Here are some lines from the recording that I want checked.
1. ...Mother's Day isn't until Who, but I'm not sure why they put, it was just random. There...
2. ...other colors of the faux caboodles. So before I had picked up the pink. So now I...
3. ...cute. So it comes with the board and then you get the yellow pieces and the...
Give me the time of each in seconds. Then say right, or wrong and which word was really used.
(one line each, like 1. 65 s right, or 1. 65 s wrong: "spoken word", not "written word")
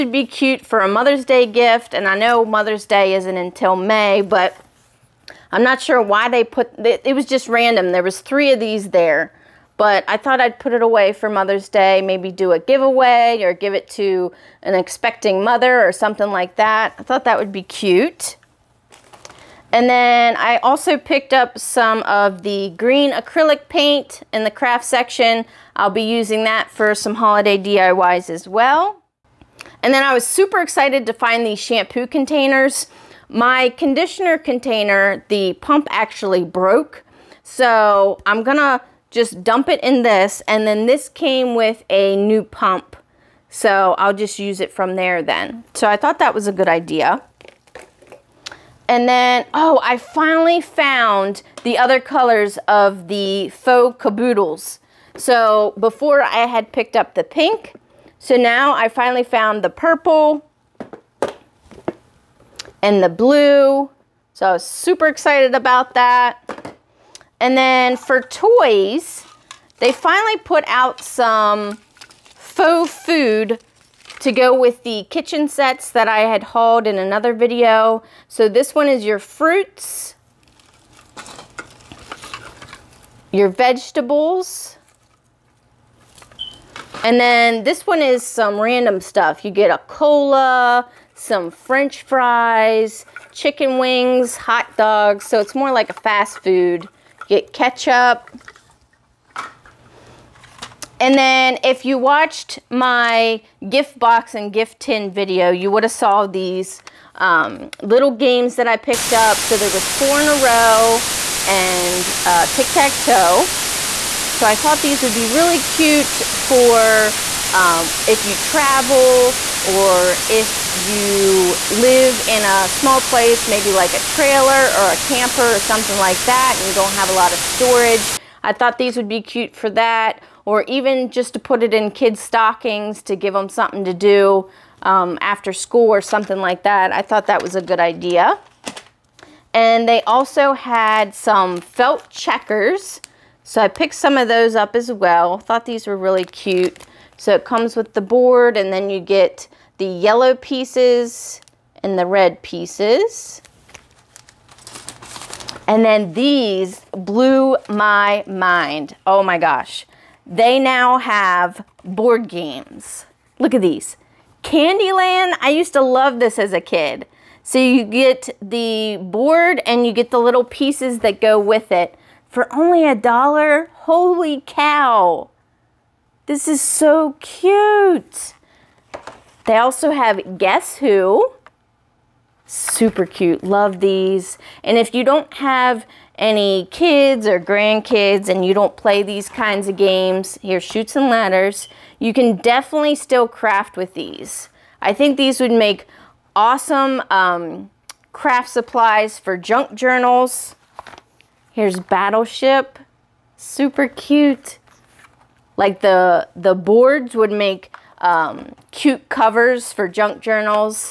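1. 2 s wrong: "May", not "Who"
2. 51 s right
3. 146 s right.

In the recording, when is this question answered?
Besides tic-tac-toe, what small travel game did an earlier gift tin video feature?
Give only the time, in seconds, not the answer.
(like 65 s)
109 s.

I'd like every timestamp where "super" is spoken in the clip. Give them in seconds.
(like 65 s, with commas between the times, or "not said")
30 s, 64 s, 182 s, 203 s.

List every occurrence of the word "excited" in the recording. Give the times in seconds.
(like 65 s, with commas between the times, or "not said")
30 s, 65 s.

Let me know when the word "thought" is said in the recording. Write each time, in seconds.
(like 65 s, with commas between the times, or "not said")
10 s, 17 s, 45 s, 114 s, 128 s, 137 s, 145 s.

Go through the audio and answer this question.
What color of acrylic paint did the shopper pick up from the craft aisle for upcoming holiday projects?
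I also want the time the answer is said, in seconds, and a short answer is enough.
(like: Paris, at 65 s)
Green, at 22 s.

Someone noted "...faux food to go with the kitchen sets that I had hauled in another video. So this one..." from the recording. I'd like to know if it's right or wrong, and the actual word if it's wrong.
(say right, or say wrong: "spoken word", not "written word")
right.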